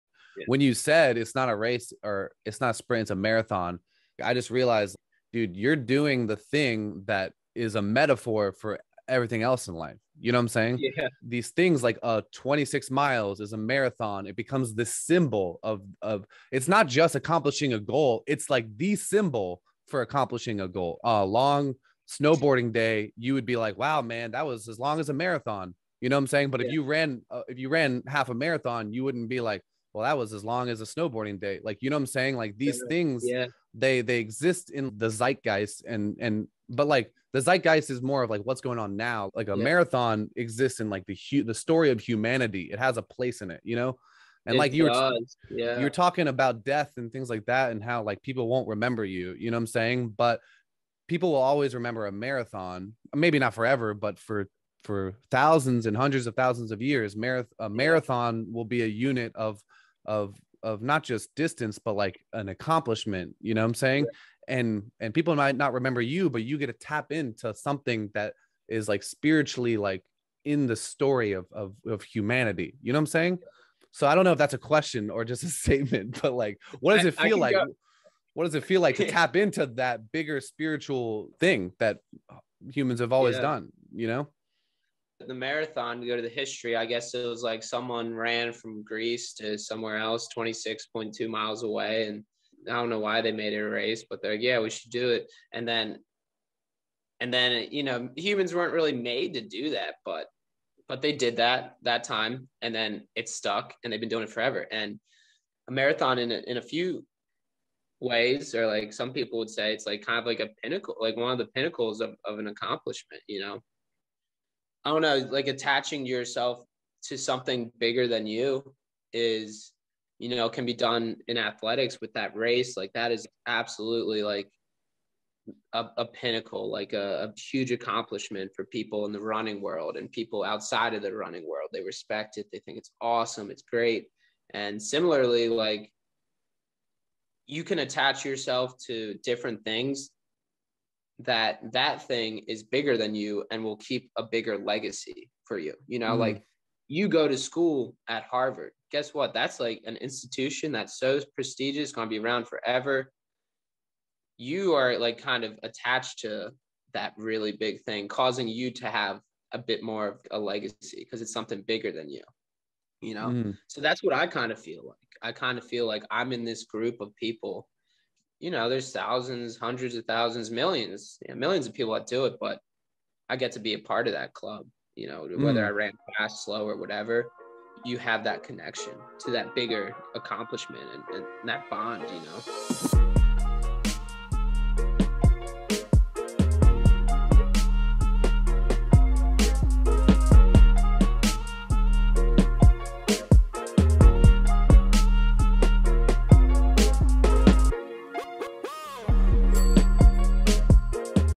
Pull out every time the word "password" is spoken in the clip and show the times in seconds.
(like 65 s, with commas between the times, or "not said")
not said.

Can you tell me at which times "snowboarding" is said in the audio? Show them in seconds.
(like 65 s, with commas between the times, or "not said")
22 s, 30 s.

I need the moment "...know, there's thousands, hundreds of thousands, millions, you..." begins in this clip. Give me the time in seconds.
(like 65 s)
168 s.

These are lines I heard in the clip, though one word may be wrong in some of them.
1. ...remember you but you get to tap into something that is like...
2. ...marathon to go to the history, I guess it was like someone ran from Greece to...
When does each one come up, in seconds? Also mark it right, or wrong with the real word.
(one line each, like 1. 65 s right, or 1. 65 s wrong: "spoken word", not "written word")
1. 65 s right
2. 85 s right.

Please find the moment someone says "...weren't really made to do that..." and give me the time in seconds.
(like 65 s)
98 s.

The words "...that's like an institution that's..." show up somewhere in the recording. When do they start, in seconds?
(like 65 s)
149 s.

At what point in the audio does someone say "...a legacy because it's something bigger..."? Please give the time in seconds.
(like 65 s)
160 s.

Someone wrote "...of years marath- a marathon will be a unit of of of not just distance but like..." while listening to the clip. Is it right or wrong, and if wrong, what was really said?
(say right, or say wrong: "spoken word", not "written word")
right.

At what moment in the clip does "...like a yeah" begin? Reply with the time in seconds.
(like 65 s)
39 s.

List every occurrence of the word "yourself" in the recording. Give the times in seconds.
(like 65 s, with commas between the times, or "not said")
116 s, 138 s.